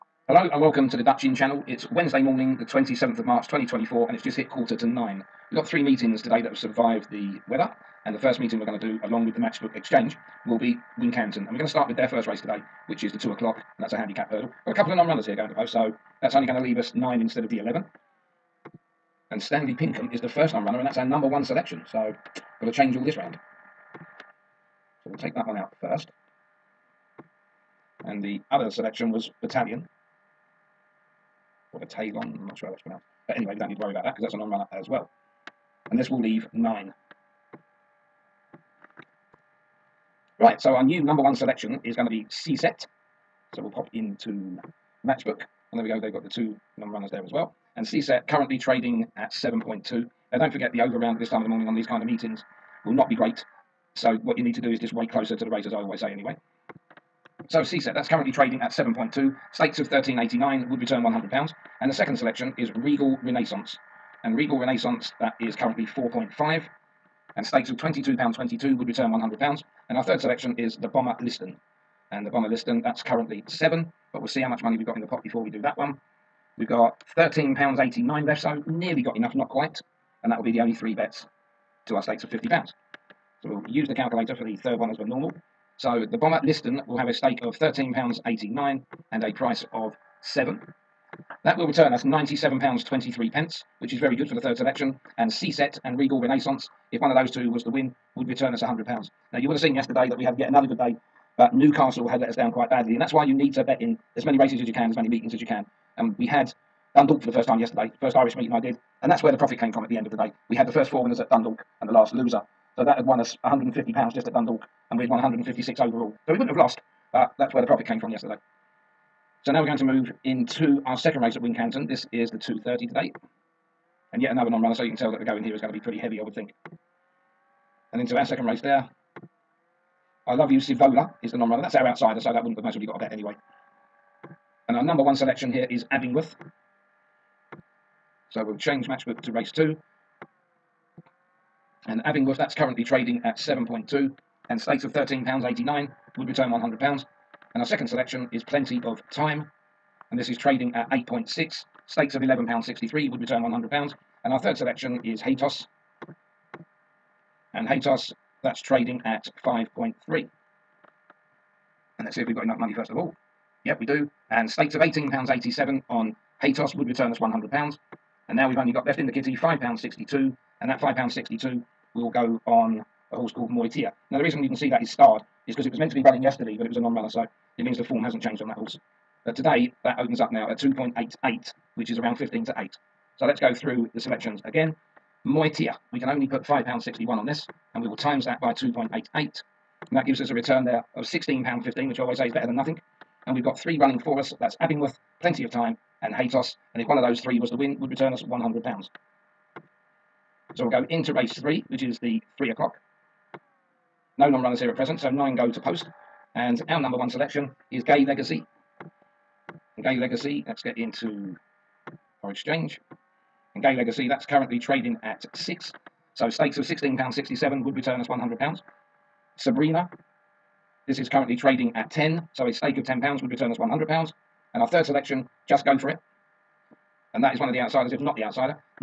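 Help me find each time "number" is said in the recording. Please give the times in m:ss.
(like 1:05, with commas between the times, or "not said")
0:21, 0:41, 2:14, 3:26.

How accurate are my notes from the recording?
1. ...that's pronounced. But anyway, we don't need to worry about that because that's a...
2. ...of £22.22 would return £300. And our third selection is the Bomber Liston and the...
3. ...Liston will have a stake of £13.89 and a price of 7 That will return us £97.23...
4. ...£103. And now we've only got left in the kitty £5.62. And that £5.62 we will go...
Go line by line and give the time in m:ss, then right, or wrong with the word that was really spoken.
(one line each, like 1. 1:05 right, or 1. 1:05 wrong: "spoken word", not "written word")
1. 0:32 right
2. 1:07 wrong: "100", not "300"
3. 1:26 right
4. 2:47 wrong: "100", not "103".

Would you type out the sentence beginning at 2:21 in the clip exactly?
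and Abingworth, that's currently trading at 7.2 and stakes of £13.89 would return £100.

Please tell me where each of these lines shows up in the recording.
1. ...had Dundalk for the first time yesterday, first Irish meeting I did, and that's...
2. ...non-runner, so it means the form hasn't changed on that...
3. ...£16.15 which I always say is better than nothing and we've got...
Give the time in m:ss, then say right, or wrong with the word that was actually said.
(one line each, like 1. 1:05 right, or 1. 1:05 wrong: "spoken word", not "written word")
1. 1:46 right
2. 2:56 right
3. 3:11 right.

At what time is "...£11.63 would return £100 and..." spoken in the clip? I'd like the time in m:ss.
2:32.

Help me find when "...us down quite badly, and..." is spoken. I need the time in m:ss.
1:42.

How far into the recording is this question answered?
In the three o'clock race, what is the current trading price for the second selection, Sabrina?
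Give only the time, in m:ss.
3:41.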